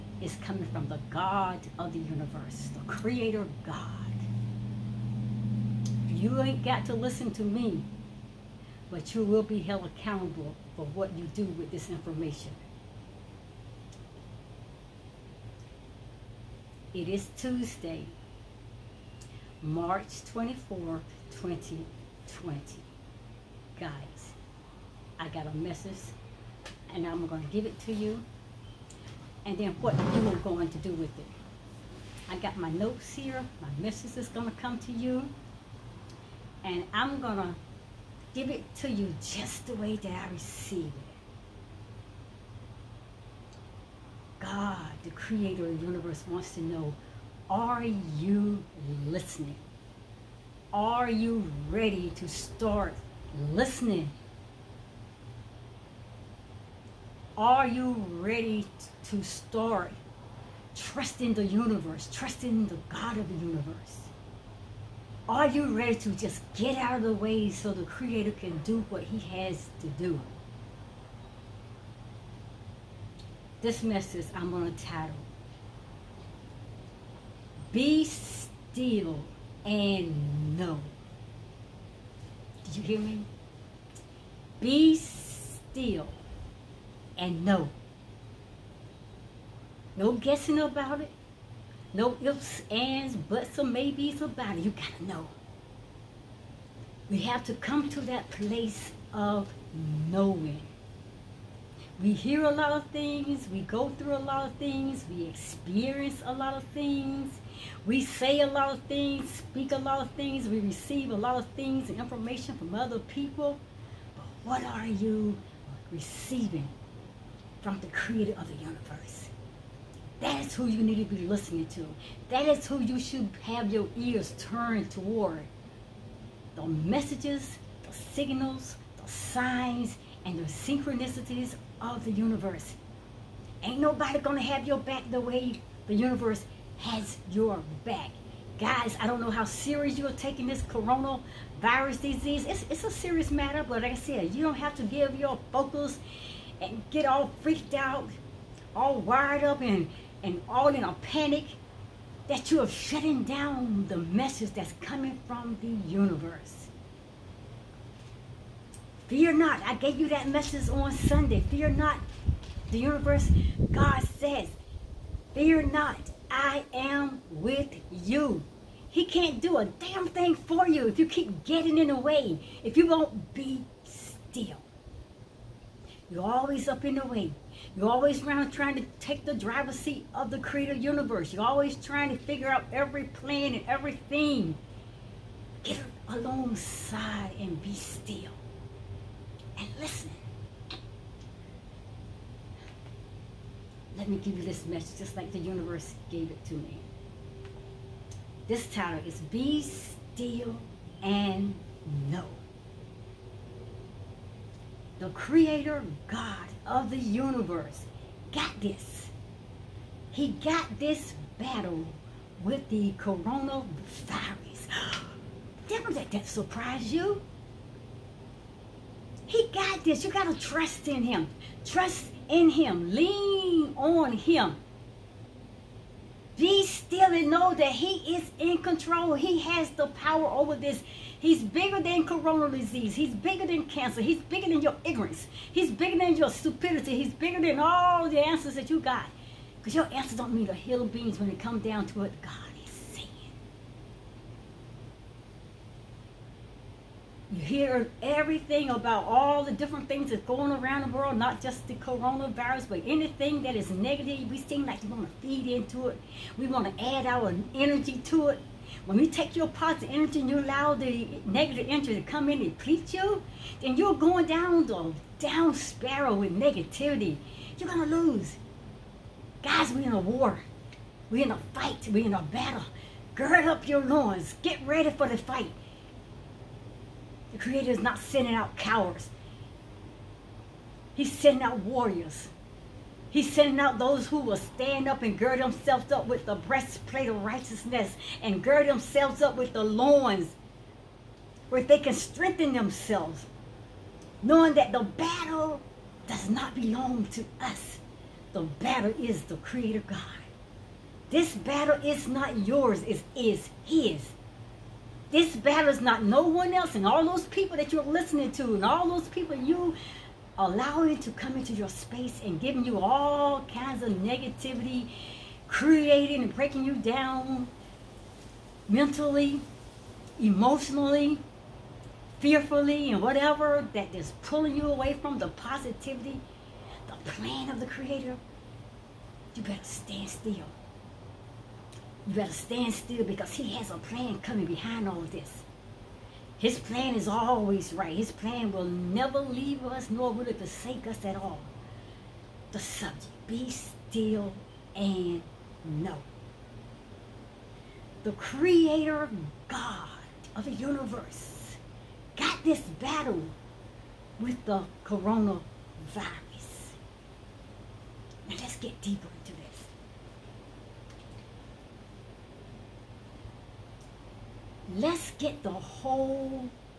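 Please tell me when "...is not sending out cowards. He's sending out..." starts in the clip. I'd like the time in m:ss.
4:37.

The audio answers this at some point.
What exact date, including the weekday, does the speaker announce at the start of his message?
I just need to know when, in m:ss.
0:17.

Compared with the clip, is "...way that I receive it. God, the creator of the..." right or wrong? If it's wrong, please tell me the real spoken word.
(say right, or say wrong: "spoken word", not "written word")
right.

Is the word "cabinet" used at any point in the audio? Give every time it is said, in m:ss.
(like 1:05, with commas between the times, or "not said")
not said.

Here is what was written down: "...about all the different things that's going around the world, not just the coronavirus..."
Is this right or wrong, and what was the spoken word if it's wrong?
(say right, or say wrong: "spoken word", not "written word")
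right.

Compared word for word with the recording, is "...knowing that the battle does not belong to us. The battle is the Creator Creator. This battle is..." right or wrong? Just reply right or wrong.
wrong.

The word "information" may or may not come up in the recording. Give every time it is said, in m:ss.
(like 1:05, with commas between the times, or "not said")
0:11, 1:51.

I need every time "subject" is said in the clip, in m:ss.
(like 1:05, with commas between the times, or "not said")
5:42.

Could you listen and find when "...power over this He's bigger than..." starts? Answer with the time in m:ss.
3:49.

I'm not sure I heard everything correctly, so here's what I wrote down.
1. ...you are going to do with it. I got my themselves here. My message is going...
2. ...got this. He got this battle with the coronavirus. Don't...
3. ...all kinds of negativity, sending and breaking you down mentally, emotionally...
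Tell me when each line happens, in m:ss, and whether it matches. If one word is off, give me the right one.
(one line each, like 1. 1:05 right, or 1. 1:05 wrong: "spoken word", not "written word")
1. 0:30 wrong: "notes", not "themselves"
2. 3:28 right
3. 5:12 wrong: "creating", not "sending".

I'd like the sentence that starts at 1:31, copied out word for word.
No ifs, ands, buts, or maybes about it.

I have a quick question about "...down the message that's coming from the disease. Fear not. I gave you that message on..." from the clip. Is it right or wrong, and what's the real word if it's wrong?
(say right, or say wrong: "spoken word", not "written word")
wrong: "universe", not "disease".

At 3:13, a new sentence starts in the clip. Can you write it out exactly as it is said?
Let me give you this message just like the universe gave it to me.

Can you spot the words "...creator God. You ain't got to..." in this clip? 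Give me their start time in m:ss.
0:02.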